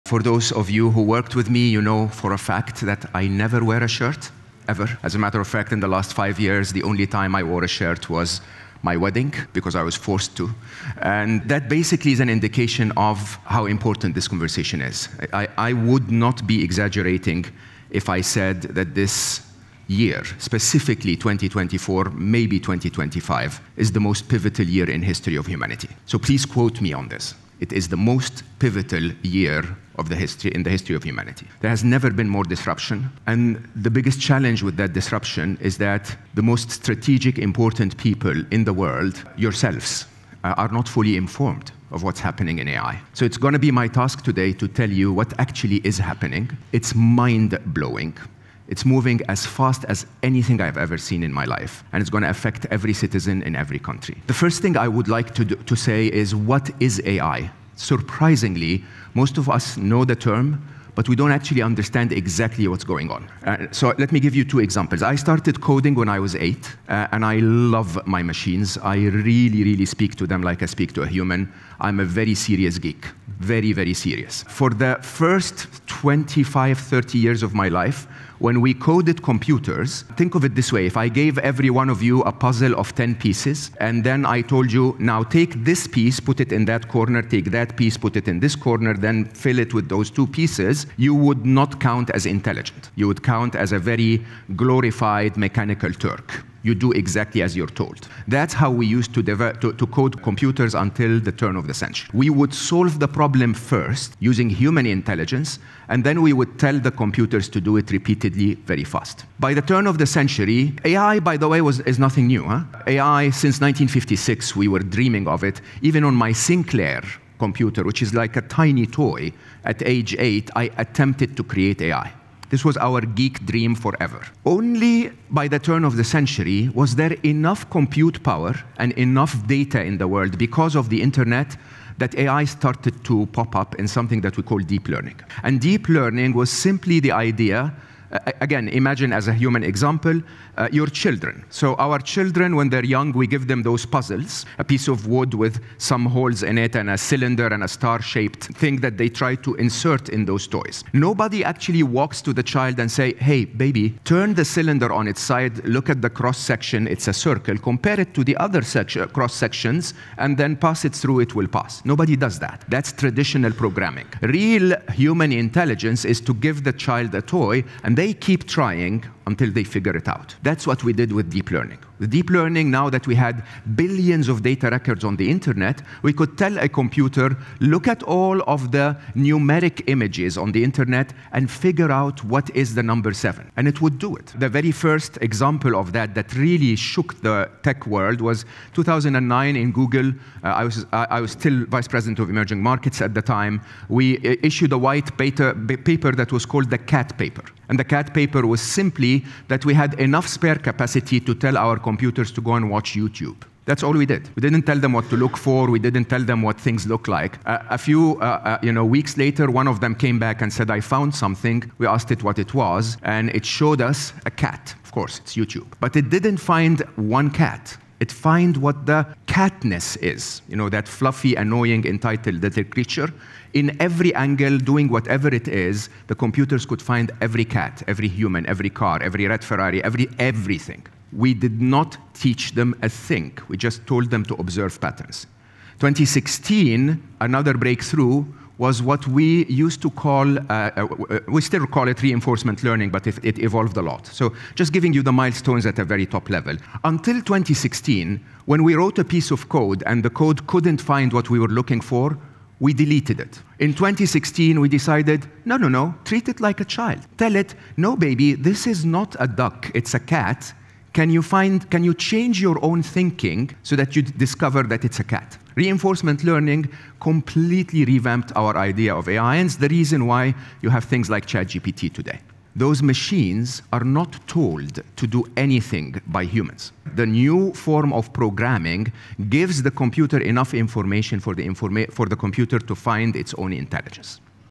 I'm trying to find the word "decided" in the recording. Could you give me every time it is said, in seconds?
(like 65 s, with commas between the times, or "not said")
254 s.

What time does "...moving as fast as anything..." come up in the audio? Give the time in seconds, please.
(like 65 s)
48 s.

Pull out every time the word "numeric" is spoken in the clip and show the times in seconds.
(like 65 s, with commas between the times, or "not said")
179 s.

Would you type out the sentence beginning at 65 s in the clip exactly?
I started coding when I was eight, uh, and I love my machines.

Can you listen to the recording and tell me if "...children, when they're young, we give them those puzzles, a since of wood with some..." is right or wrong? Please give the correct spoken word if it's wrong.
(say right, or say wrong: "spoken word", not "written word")
wrong: "piece", not "since".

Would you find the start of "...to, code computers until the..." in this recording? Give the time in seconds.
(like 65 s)
99 s.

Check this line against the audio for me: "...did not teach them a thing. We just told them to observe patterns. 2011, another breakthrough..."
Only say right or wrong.
wrong.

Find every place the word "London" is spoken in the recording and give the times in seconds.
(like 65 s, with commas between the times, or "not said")
not said.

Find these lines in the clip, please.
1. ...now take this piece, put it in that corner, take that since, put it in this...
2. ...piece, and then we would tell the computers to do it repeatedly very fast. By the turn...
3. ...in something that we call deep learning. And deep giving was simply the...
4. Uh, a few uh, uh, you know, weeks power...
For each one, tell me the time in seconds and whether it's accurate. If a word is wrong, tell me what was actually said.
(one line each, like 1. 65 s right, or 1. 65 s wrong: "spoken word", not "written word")
1. 84 s wrong: "piece", not "since"
2. 104 s wrong: "intelligence", not "piece"
3. 133 s wrong: "learning", not "giving"
4. 207 s wrong: "later", not "power".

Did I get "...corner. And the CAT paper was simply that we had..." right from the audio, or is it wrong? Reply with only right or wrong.
wrong.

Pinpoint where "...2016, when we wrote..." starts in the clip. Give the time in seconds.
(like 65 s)
247 s.